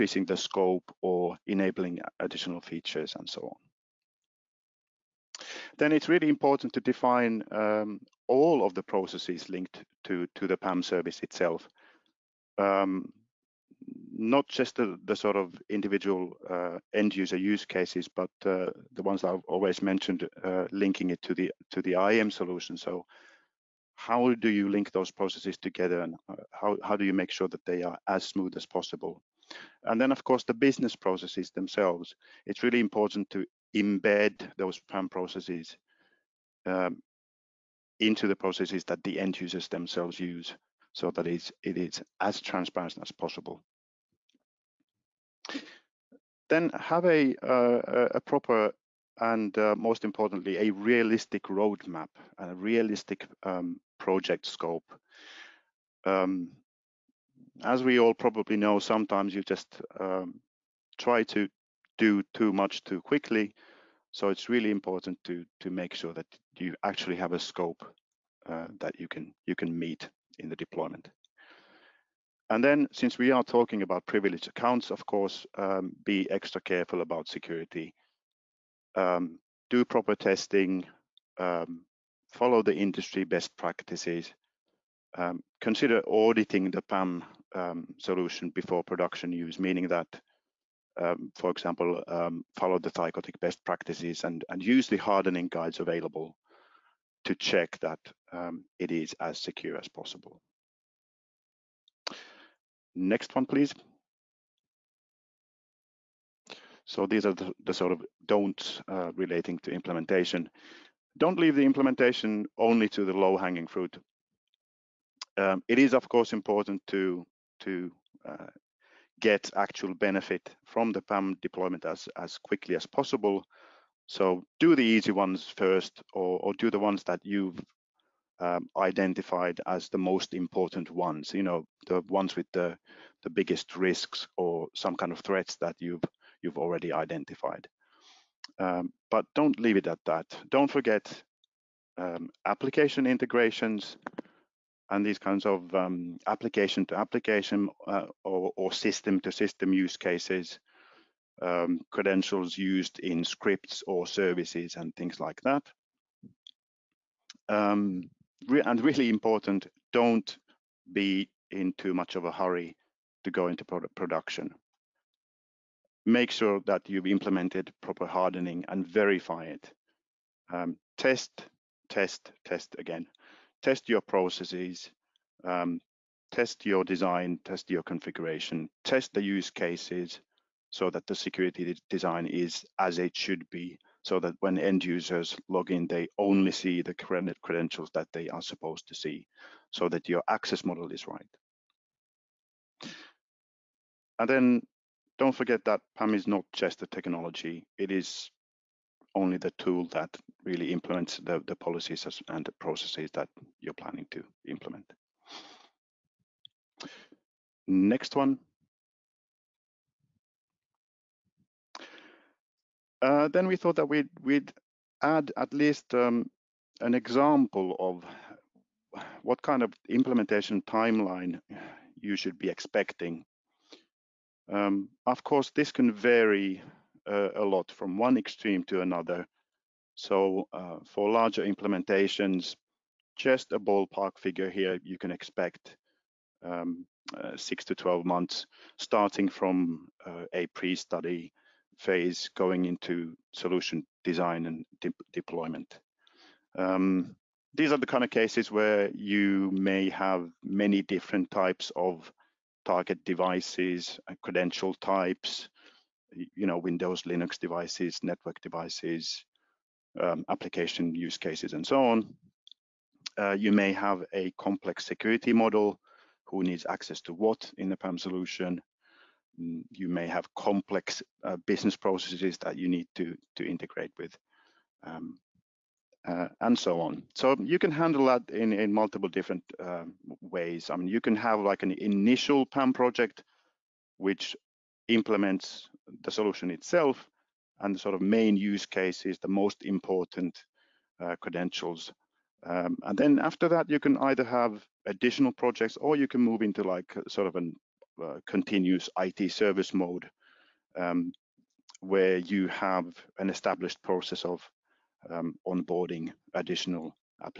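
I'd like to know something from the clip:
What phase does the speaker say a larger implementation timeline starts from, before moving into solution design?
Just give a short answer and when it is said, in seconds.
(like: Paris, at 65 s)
pre-study phase, at 240 s.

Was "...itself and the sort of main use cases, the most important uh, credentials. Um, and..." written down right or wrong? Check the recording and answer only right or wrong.
right.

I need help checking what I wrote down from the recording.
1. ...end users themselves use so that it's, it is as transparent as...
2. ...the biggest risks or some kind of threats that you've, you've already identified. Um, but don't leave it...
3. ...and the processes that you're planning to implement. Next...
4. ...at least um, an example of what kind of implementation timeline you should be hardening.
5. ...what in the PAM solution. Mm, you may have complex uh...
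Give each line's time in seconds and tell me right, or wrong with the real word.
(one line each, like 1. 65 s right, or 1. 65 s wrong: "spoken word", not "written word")
1. 39 s right
2. 133 s right
3. 202 s right
4. 215 s wrong: "expecting", not "hardening"
5. 267 s right.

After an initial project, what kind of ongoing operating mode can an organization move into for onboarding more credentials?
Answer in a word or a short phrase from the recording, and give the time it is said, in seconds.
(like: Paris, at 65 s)
continuous IT service mode, at 298 s.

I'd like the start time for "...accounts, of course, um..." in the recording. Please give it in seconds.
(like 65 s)
74 s.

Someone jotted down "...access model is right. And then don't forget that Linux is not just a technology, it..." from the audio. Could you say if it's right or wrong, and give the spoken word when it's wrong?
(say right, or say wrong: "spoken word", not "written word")
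wrong: "PAM", not "Linux".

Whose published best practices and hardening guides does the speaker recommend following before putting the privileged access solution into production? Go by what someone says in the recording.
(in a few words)
Thycotic.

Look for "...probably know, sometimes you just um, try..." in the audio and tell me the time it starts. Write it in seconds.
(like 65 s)
58 s.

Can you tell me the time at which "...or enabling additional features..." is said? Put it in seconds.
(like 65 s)
1 s.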